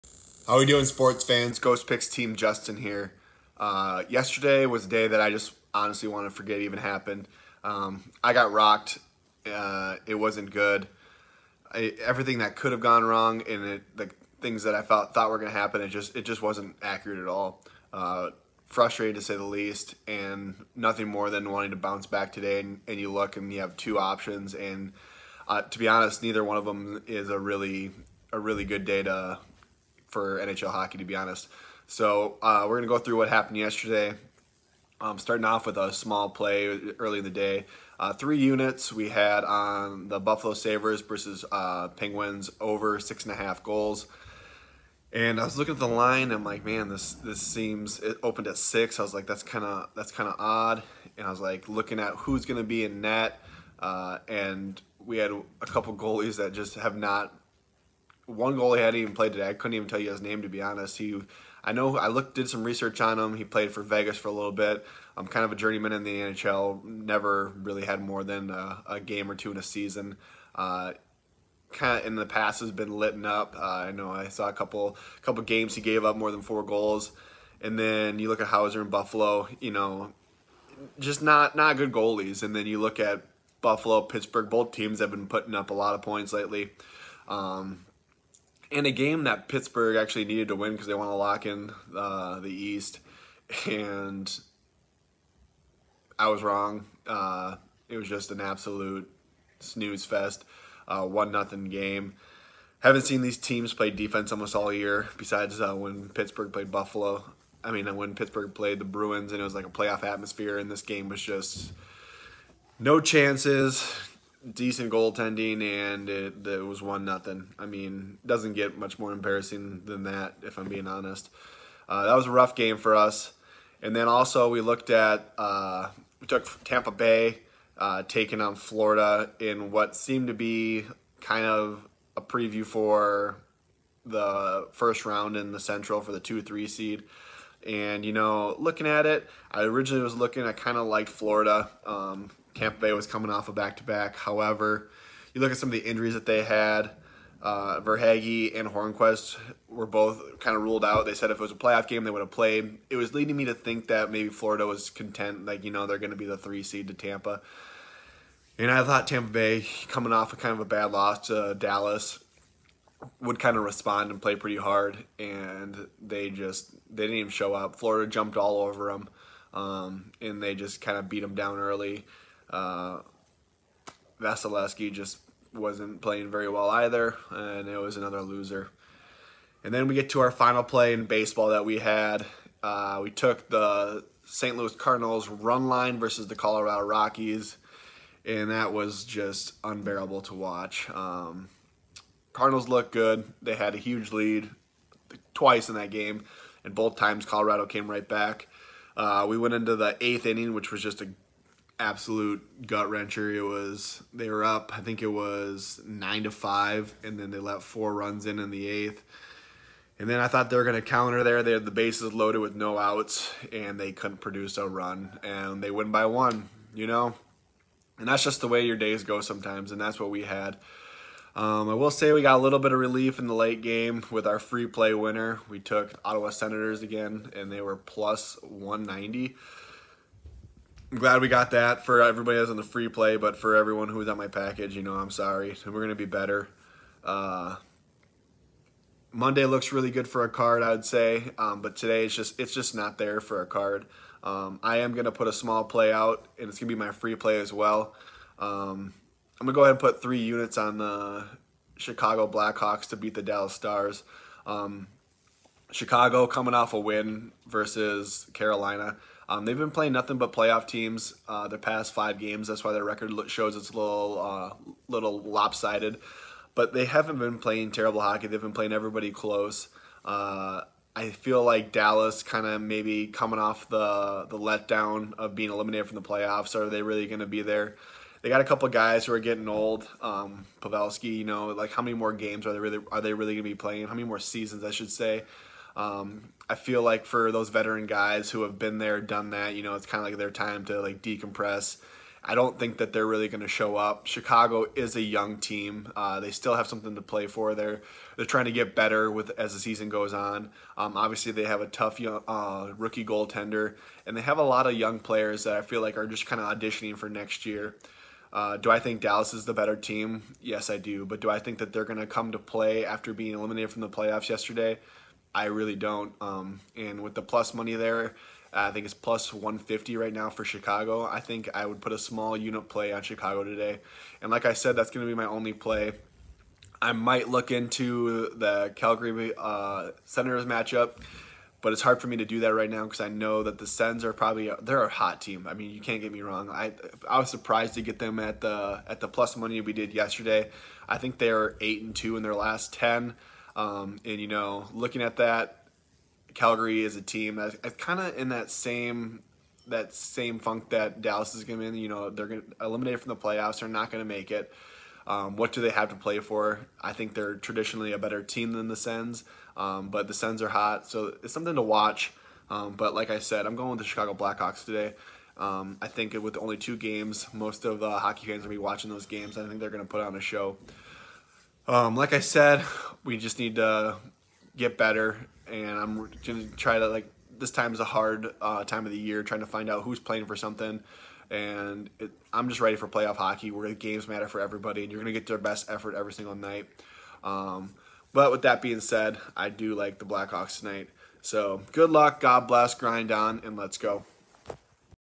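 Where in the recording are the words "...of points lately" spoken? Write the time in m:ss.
1:25.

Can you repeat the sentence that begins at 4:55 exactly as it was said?
Uh, they still have something to play for.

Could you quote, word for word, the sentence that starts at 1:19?
You know, just not not good goalies.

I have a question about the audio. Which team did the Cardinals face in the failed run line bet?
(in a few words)
Colorado Rockies.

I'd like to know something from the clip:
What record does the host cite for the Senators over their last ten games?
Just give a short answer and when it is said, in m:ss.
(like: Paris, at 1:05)
8-2, at 5:41.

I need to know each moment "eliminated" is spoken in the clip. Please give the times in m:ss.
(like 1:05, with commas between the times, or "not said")
4:35, 5:13, 5:52.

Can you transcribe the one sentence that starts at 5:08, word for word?
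Uh, do I think Dallas is the better team?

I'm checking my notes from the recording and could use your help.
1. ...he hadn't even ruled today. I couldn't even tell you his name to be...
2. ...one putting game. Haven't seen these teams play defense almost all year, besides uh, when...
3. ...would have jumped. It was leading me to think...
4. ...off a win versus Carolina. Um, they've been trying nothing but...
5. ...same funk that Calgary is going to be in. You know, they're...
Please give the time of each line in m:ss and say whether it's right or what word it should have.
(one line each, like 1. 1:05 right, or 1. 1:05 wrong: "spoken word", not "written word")
1. 0:58 wrong: "played", not "ruled"
2. 1:41 wrong: "nothing", not "putting"
3. 2:32 wrong: "played", not "jumped"
4. 4:16 wrong: "playing", not "trying"
5. 5:49 wrong: "Dallas", not "Calgary".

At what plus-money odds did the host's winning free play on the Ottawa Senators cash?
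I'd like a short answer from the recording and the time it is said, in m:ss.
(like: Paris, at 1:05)
+190, at 3:47.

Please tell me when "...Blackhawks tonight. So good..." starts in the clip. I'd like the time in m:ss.
6:30.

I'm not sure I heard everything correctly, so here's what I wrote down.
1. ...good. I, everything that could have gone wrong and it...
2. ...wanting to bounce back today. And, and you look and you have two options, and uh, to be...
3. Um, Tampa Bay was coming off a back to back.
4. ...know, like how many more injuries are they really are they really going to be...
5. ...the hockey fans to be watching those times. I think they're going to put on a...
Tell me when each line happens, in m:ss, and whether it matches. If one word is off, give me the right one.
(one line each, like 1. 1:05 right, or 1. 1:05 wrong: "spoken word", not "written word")
1. 0:10 right
2. 0:21 right
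3. 2:21 right
4. 4:41 wrong: "games", not "injuries"
5. 6:07 wrong: "games", not "times".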